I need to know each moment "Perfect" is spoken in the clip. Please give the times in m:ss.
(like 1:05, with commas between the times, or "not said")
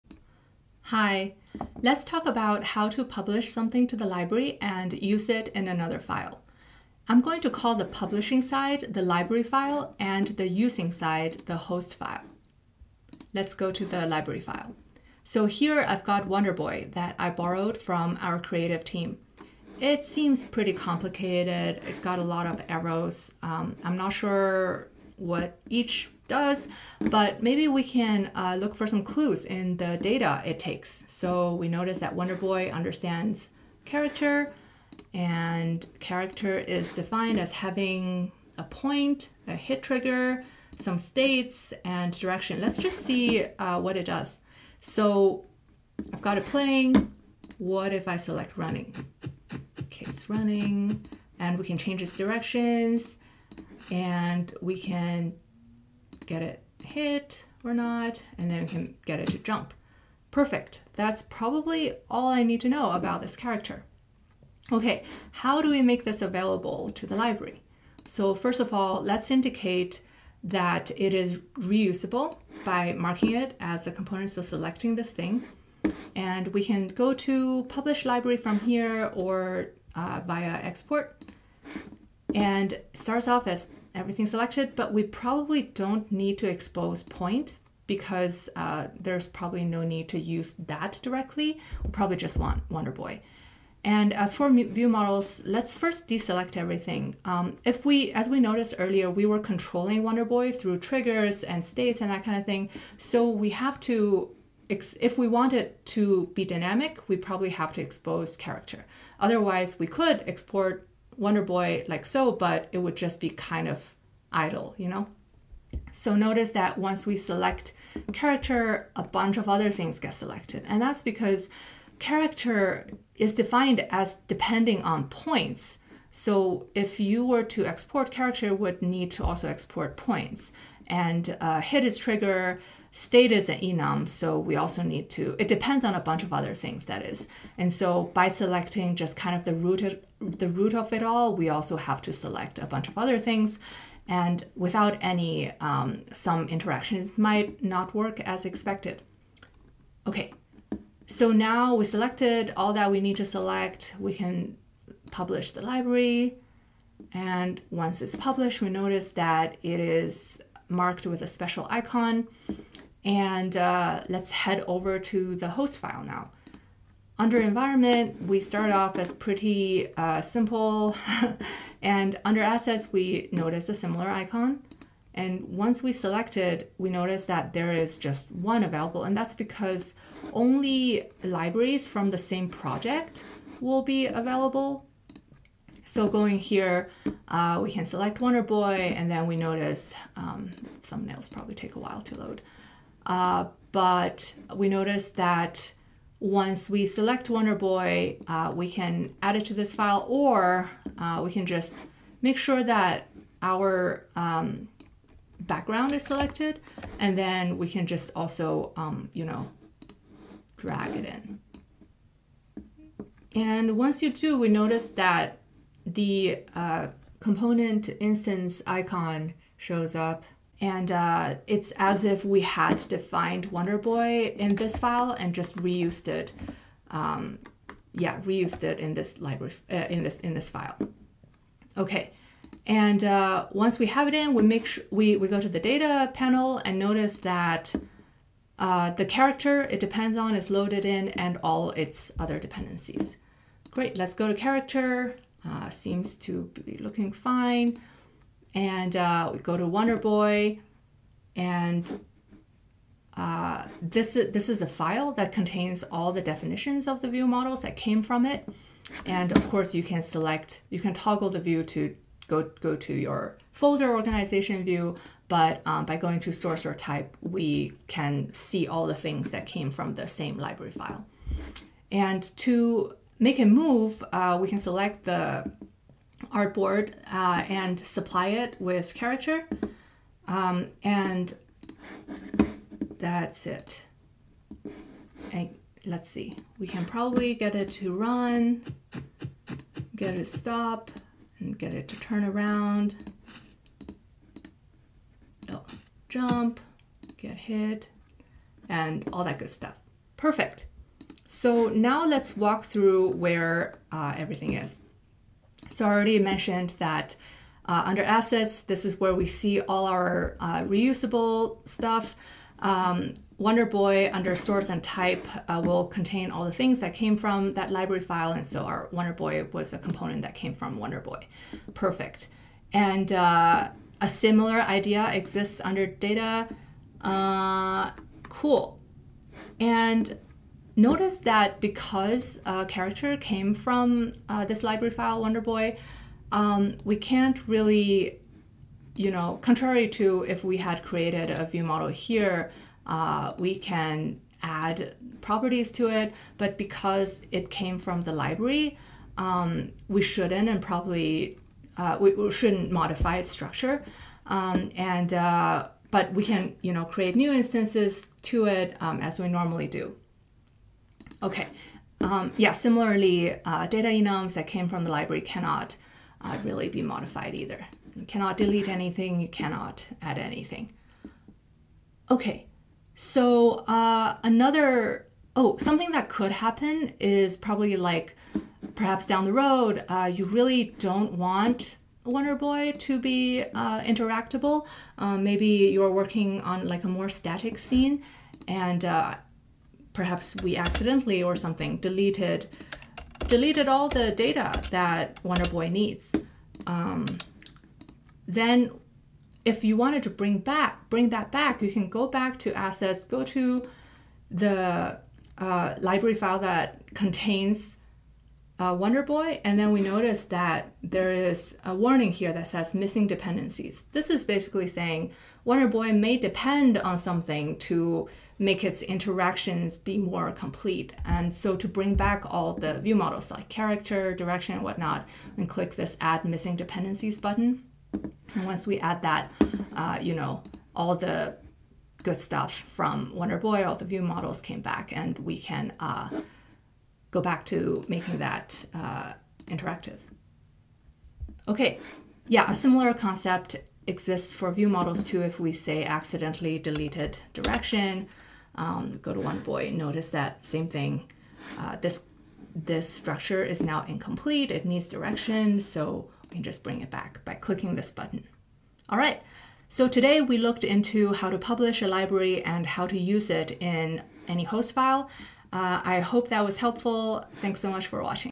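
1:00, 5:00, 5:21.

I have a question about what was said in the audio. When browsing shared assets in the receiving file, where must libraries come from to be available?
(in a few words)
The same project.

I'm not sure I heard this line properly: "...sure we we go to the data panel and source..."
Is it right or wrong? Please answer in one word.
wrong.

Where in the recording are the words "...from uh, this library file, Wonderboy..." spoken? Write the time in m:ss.
5:33.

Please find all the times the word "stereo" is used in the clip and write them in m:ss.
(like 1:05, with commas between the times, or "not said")
not said.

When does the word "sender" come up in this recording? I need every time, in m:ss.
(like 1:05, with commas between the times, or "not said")
not said.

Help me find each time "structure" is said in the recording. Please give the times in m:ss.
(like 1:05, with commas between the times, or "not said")
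5:53, 7:32.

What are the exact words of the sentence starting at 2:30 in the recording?
Okay, so now we selected all that we need to select.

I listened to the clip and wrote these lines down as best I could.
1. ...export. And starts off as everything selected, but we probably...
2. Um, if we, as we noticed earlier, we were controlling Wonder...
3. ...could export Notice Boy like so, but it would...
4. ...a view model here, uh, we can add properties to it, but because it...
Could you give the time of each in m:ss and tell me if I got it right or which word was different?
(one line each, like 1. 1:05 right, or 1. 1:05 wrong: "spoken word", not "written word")
1. 1:20 right
2. 1:37 right
3. 1:49 wrong: "Wonder", not "Notice"
4. 5:41 right.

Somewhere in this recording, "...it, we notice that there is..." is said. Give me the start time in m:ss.
2:56.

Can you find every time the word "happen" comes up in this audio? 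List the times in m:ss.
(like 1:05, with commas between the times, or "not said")
6:16.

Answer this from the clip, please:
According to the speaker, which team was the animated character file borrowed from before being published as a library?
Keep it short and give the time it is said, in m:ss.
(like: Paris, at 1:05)
Creative team, at 0:18.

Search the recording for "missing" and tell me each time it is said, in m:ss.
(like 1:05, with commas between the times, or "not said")
6:52, 7:06.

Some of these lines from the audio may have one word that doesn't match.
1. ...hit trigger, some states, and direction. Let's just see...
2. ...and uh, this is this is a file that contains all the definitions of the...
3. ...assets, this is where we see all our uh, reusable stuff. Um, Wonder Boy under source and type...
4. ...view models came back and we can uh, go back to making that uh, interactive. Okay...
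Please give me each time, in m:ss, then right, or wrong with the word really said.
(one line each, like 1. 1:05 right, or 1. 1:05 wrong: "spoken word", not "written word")
1. 0:39 right
2. 4:11 right
3. 5:08 right
4. 7:13 right.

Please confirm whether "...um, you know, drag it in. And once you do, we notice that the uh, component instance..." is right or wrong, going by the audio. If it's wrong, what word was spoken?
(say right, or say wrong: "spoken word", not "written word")
right.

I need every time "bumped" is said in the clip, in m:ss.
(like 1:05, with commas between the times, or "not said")
not said.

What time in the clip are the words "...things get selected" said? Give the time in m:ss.
1:59.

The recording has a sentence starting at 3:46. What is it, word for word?
Um, yeah, reused it in this library uh, in this in this file.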